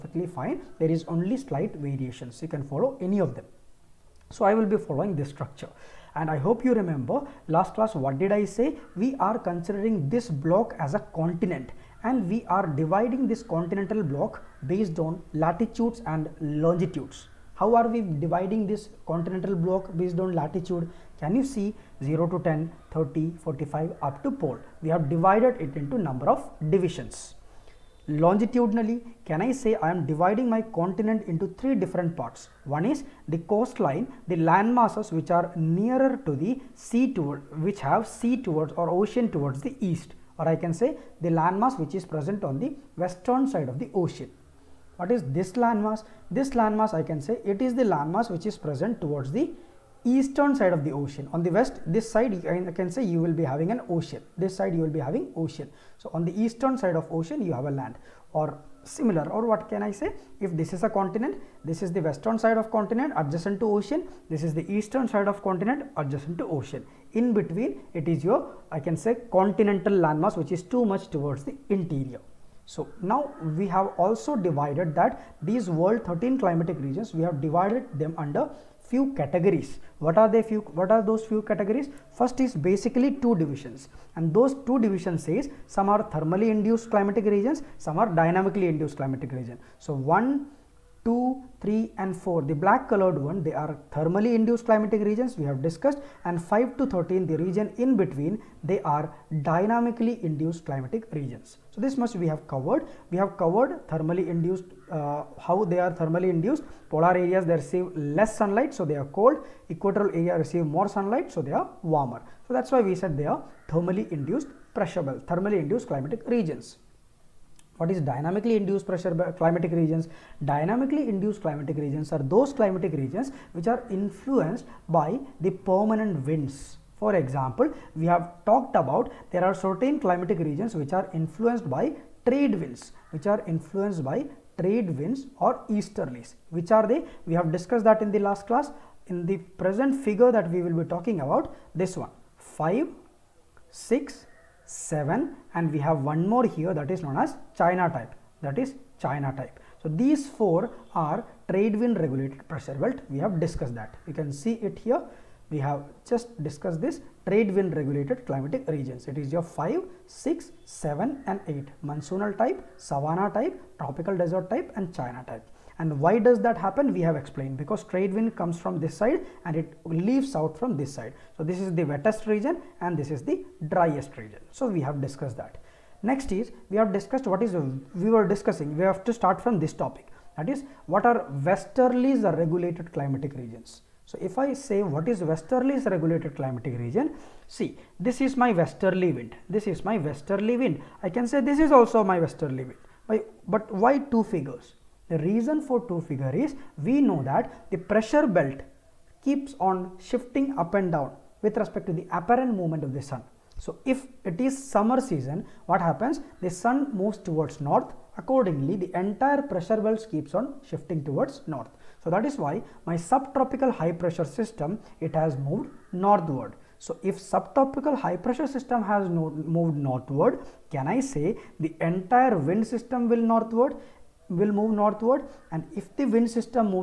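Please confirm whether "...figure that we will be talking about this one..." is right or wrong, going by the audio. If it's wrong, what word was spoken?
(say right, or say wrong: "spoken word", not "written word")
right.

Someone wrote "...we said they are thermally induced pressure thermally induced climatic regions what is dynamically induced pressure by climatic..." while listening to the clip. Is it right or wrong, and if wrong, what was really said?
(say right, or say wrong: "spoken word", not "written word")
right.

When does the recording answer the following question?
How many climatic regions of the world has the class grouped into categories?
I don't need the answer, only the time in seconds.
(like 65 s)
76 s.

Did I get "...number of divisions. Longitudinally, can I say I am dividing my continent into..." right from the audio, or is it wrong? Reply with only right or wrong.
right.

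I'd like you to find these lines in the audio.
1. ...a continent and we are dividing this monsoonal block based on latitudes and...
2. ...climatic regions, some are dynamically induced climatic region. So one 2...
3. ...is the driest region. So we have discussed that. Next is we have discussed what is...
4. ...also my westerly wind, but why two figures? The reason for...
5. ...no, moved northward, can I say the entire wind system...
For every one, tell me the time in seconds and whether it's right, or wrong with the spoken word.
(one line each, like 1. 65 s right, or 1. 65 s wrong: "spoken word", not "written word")
1. 10 s wrong: "continental", not "monsoonal"
2. 86 s right
3. 173 s right
4. 191 s right
5. 219 s right.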